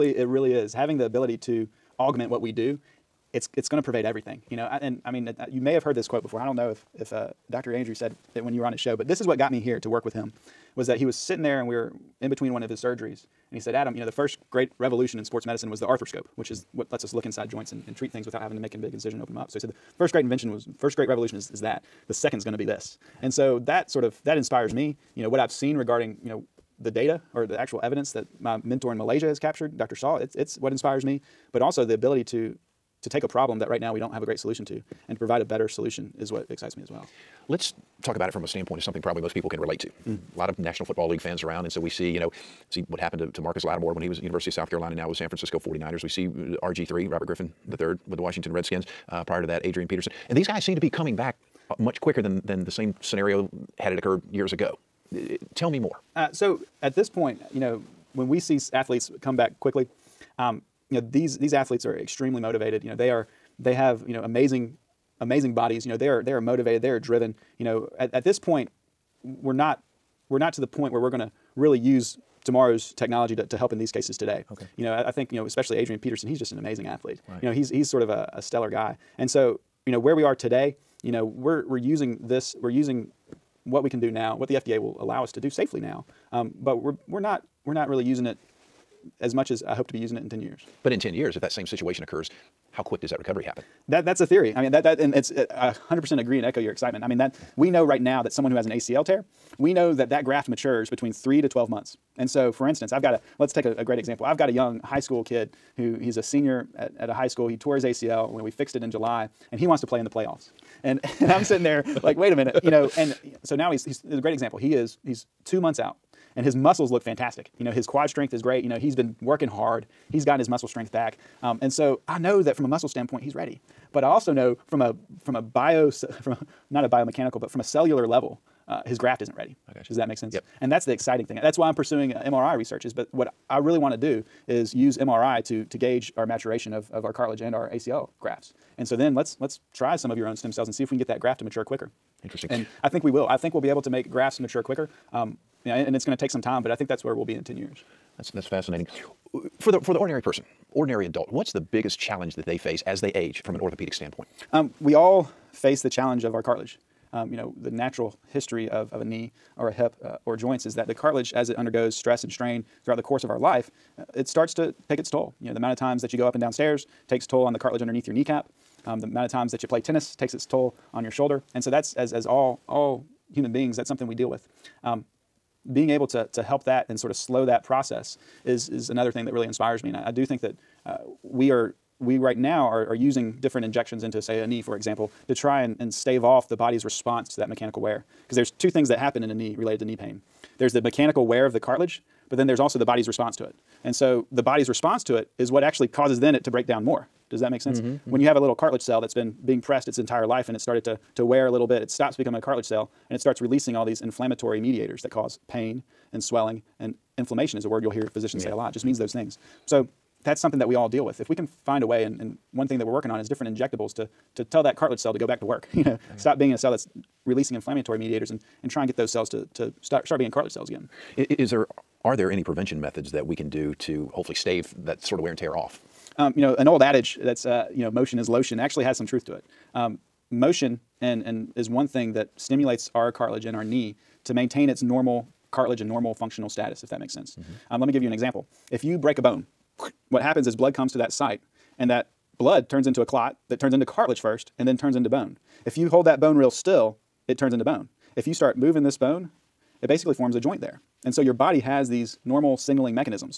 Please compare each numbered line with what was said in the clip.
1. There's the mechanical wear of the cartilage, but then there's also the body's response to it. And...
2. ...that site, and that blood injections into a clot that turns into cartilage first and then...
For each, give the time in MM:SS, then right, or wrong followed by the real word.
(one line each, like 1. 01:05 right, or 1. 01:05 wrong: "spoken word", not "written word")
1. 03:10 right
2. 04:00 wrong: "turns", not "injections".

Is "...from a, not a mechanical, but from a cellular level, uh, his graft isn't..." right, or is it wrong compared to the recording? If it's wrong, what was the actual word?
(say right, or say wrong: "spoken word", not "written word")
wrong: "biomechanical", not "mechanical".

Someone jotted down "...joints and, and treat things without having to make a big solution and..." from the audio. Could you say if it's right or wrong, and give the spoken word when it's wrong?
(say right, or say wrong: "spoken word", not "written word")
wrong: "incision", not "solution".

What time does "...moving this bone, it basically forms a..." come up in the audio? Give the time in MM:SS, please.
04:08.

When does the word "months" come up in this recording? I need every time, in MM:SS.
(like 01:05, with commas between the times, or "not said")
01:41, 01:55.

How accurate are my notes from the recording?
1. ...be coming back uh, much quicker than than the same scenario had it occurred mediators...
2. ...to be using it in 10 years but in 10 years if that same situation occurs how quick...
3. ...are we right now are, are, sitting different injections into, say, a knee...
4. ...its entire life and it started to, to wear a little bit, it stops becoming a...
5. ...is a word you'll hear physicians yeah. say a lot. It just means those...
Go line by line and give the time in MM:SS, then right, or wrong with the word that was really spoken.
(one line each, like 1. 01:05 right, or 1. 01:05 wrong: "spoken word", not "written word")
1. 00:50 wrong: "years", not "mediators"
2. 01:29 right
3. 03:01 wrong: "using", not "sitting"
4. 03:19 right
5. 03:27 right.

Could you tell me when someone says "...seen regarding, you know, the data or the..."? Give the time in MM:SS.
00:25.